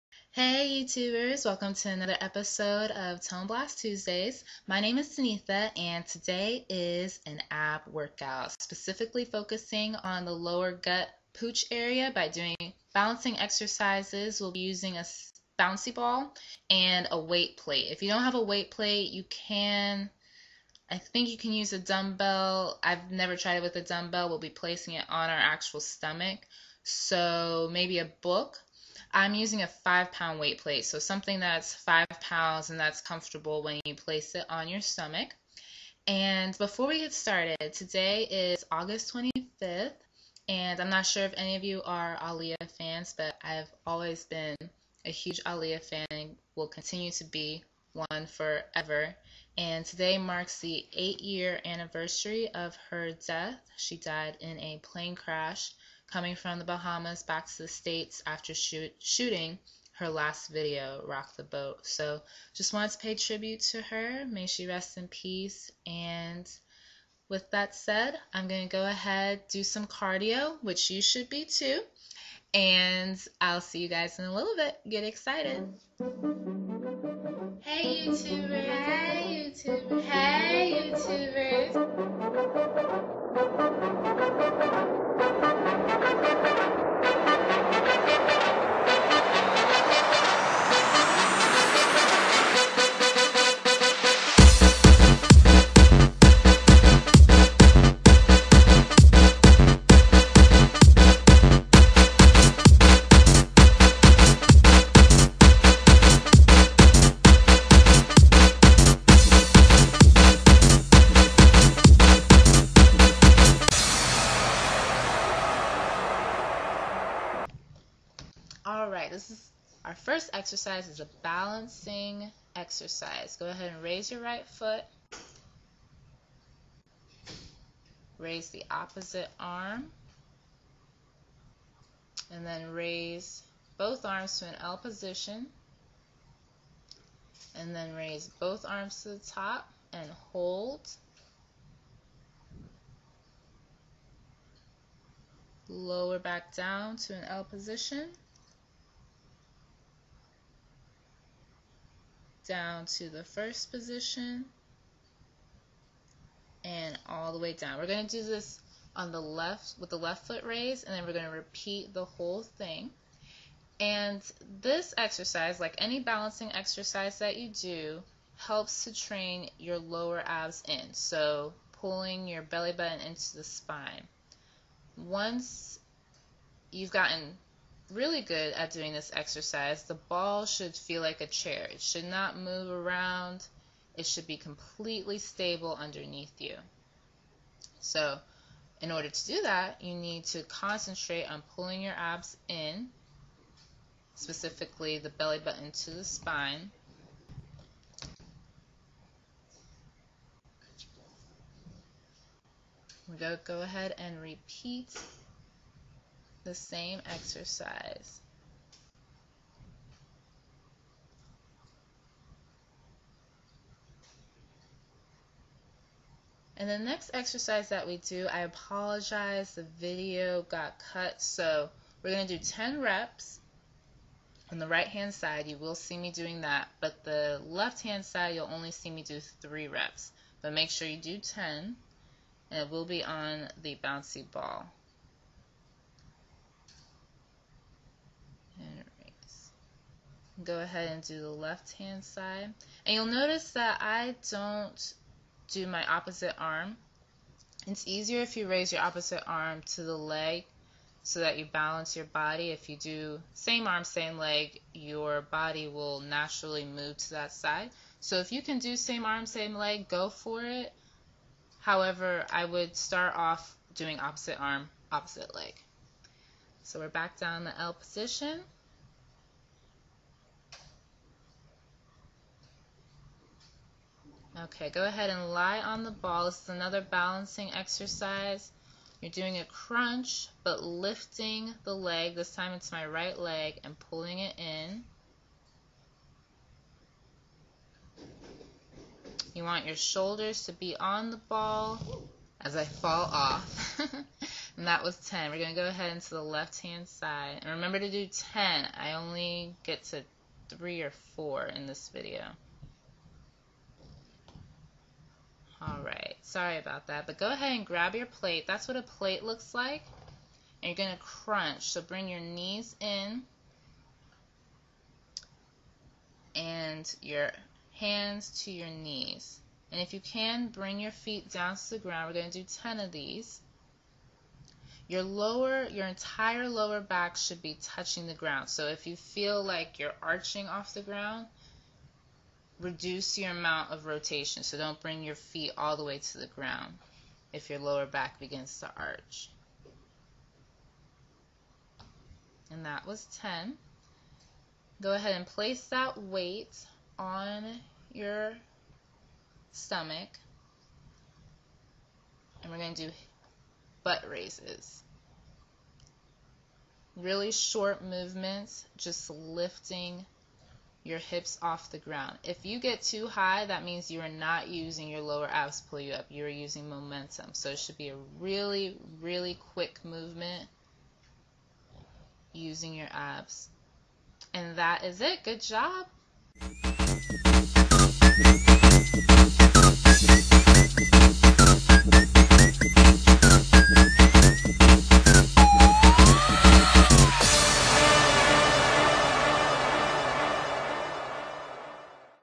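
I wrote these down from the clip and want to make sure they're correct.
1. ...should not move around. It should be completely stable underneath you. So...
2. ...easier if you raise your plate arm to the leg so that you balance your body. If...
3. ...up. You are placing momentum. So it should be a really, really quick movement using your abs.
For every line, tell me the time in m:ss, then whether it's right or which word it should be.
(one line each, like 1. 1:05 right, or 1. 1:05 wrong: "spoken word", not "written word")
1. 3:01 right
2. 4:07 wrong: "opposite", not "plate"
3. 6:05 wrong: "using", not "placing".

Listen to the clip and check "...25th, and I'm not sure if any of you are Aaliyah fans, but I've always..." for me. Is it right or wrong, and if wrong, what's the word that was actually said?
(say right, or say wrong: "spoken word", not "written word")
right.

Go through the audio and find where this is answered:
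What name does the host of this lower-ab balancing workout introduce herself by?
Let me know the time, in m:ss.
0:05.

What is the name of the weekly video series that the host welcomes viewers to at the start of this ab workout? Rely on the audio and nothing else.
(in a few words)
Tone Blast Tuesdays.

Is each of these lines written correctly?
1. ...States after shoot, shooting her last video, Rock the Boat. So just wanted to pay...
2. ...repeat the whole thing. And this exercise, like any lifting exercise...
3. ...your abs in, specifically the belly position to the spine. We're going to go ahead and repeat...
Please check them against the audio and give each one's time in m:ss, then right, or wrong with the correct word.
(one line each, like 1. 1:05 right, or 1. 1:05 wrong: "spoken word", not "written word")
1. 0:57 right
2. 2:41 wrong: "balancing", not "lifting"
3. 3:11 wrong: "button", not "position".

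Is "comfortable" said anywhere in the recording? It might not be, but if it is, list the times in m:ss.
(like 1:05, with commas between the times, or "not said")
0:33.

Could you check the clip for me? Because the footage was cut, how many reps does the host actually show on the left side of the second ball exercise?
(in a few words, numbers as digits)
3.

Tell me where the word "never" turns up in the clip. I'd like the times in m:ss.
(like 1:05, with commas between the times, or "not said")
0:23.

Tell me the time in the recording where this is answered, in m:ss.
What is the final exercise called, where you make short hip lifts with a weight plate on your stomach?
5:53.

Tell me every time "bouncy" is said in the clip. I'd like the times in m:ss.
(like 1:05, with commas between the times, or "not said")
0:15, 3:53.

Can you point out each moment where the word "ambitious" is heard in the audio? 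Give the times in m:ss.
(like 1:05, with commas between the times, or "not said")
not said.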